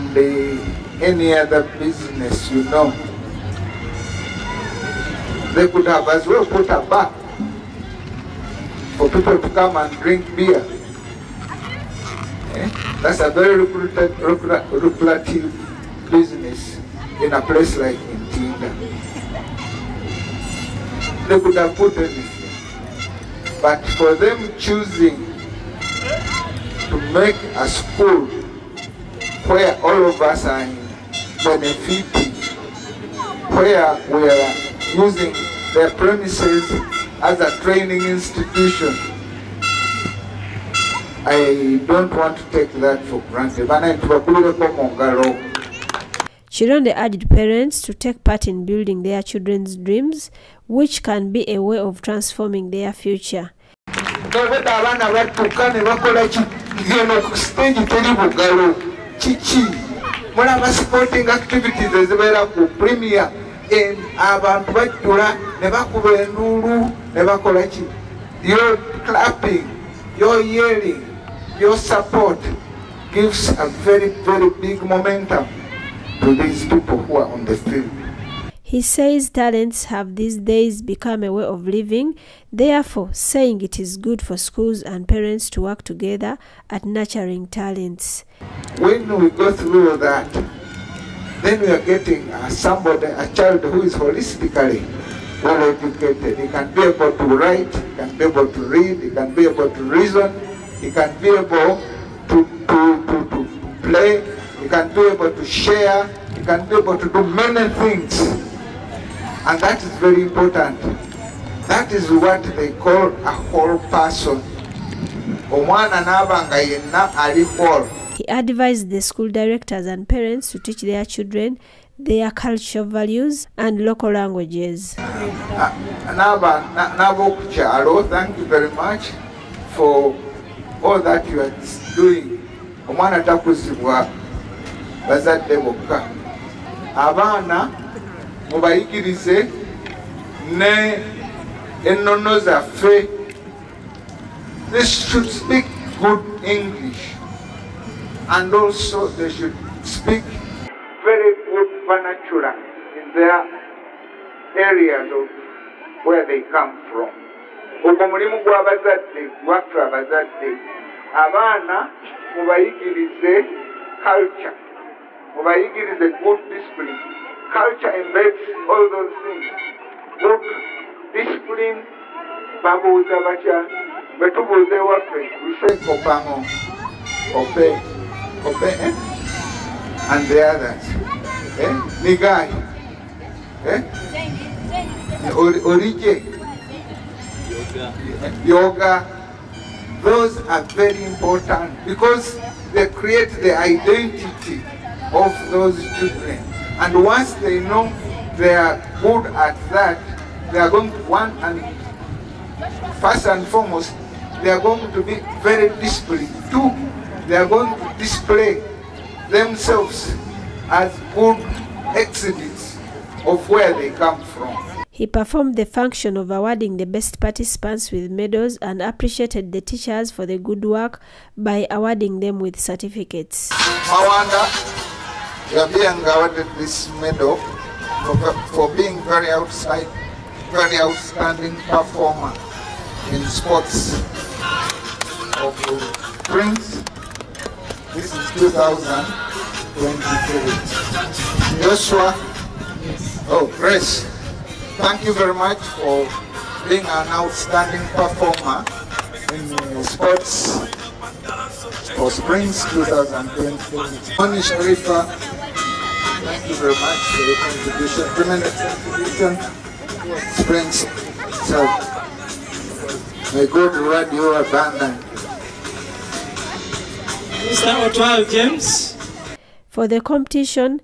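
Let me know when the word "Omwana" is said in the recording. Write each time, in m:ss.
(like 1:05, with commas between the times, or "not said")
1:55, 2:12.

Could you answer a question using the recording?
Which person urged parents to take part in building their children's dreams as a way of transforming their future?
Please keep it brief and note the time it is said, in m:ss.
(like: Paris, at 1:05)
Kironde, at 0:46.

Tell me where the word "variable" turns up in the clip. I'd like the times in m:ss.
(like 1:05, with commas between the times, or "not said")
not said.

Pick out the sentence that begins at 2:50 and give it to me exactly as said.
Look, discipline, babuuza batya Metu tubuuza We say obamo obe obe eh?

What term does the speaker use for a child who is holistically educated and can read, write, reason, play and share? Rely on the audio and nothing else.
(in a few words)
whole person.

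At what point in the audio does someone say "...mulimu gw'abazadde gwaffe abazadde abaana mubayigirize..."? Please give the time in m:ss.
2:38.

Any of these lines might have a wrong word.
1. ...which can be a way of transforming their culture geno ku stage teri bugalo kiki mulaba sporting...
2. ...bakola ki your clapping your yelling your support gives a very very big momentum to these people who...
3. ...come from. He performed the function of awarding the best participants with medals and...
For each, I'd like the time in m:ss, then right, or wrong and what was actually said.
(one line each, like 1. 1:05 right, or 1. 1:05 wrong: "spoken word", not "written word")
1. 0:50 wrong: "future", not "culture"
2. 1:07 right
3. 3:33 right.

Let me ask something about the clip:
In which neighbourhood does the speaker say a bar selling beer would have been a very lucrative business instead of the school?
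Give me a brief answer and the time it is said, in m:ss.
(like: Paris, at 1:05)
Ntinda, at 0:18.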